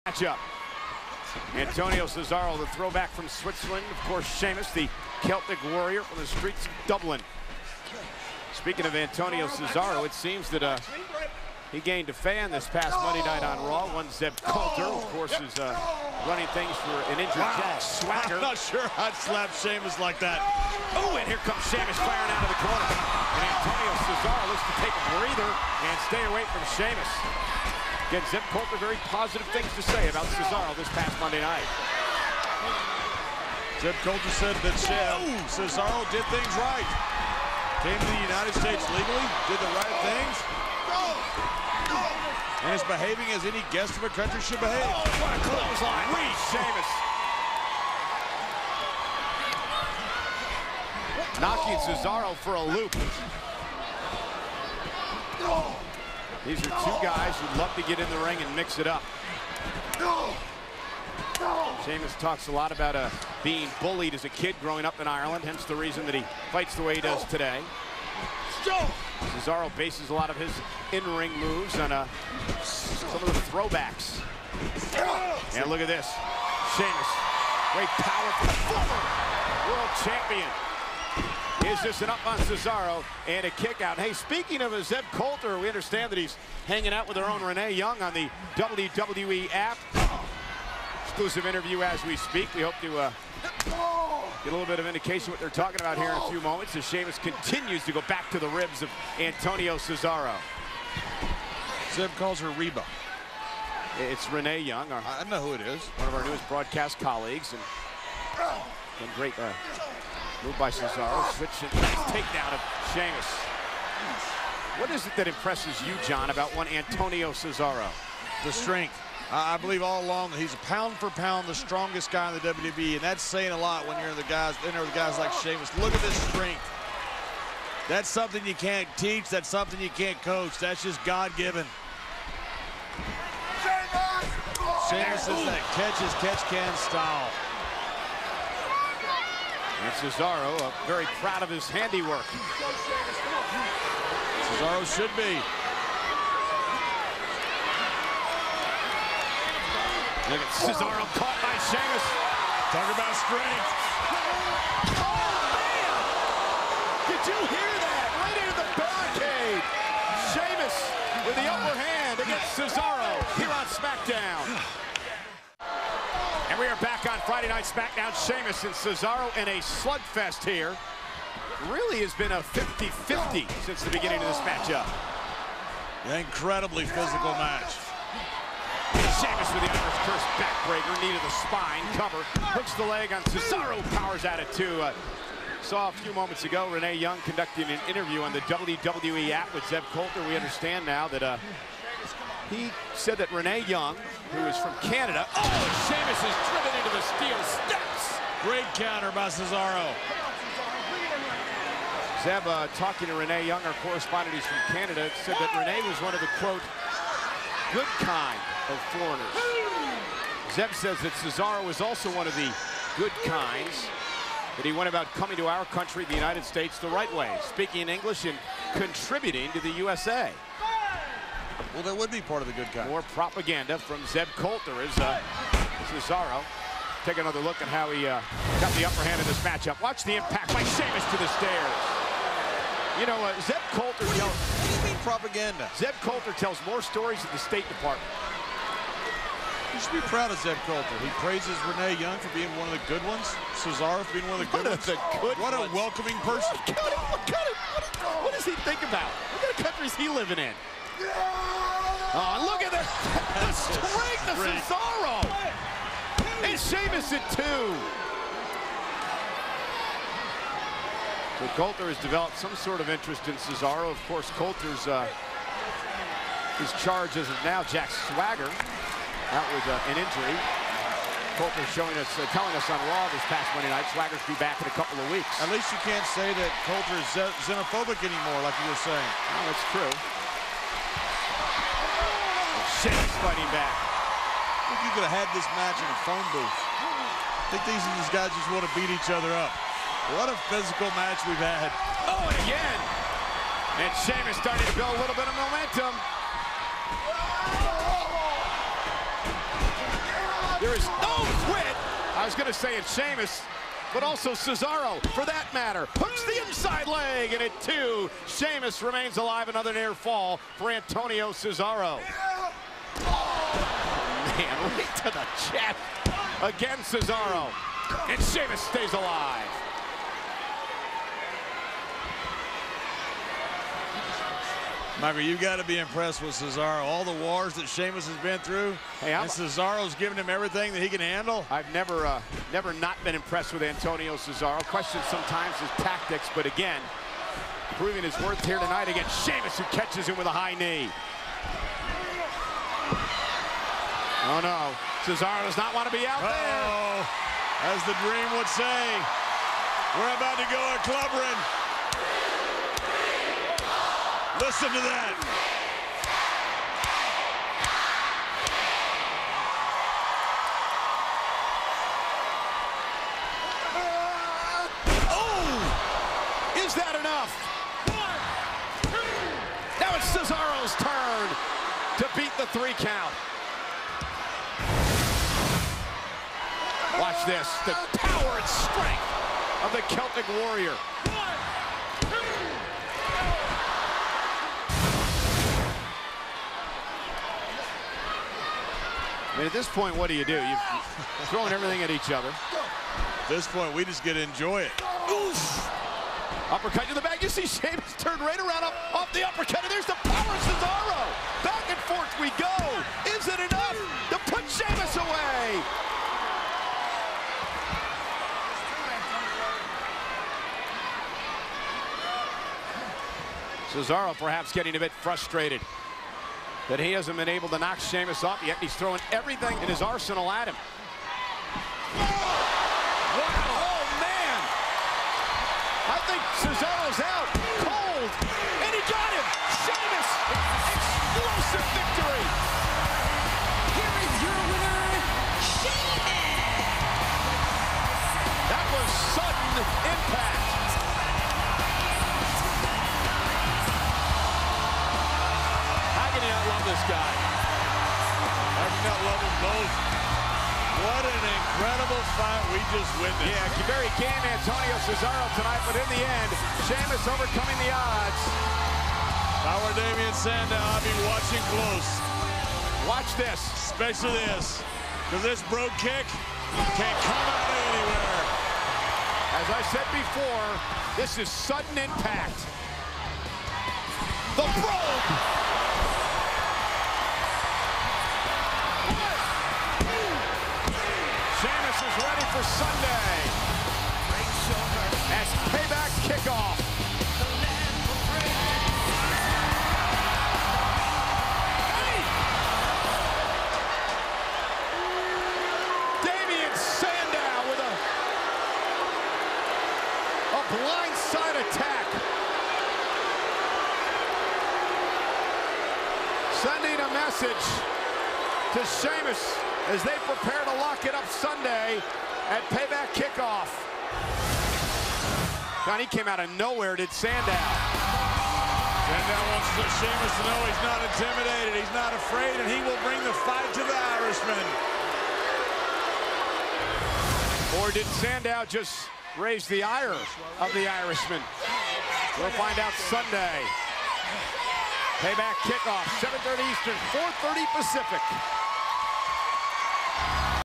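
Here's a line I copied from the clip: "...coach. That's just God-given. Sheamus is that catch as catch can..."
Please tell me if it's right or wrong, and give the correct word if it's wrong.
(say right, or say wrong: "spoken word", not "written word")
right.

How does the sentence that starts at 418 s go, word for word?
He's throwing everything in his arsenal at him.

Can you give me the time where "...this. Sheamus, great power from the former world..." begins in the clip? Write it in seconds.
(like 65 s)
75 s.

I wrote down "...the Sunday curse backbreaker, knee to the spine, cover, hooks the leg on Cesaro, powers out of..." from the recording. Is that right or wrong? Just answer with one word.
wrong.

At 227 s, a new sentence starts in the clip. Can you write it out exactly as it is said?
Take another look at how he uh, got the upper hand in this matchup.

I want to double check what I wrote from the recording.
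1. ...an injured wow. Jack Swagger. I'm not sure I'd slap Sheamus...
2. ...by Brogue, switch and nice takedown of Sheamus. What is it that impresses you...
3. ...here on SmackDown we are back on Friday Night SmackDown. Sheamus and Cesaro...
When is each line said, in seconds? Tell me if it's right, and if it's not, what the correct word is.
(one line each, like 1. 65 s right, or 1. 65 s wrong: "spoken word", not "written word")
1. 17 s right
2. 110 s wrong: "Cesaro", not "Brogue"
3. 163 s right.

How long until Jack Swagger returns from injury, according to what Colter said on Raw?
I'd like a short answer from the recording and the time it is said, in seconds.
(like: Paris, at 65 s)
A couple of weeks, at 274 s.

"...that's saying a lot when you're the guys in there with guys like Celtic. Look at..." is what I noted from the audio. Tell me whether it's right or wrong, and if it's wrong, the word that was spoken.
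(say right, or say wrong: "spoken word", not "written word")
wrong: "Sheamus", not "Celtic".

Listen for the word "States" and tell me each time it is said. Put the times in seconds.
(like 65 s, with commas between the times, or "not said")
38 s, 216 s, 237 s.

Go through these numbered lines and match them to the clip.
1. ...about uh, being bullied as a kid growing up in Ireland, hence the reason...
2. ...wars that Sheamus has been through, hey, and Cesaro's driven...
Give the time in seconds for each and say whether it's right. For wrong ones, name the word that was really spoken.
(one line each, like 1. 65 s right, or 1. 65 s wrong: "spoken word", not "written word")
1. 62 s right
2. 327 s wrong: "given", not "driven".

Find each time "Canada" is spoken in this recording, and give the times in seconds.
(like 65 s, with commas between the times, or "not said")
194 s, 204 s.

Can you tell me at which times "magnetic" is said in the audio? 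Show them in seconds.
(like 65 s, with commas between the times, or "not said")
not said.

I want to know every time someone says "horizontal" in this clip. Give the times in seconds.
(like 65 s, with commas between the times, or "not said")
not said.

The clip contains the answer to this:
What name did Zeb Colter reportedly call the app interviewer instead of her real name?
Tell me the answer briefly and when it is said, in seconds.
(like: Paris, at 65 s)
Reba, at 102 s.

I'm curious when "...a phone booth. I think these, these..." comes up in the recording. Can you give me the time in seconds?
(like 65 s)
285 s.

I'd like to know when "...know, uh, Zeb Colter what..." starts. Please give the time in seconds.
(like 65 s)
233 s.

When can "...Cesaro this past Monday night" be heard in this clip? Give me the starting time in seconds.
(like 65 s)
30 s.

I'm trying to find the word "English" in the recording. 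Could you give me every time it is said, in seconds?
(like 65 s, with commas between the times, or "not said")
217 s.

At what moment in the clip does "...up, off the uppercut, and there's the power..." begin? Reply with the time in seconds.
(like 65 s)
398 s.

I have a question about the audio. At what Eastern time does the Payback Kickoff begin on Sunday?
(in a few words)
7:30 Eastern.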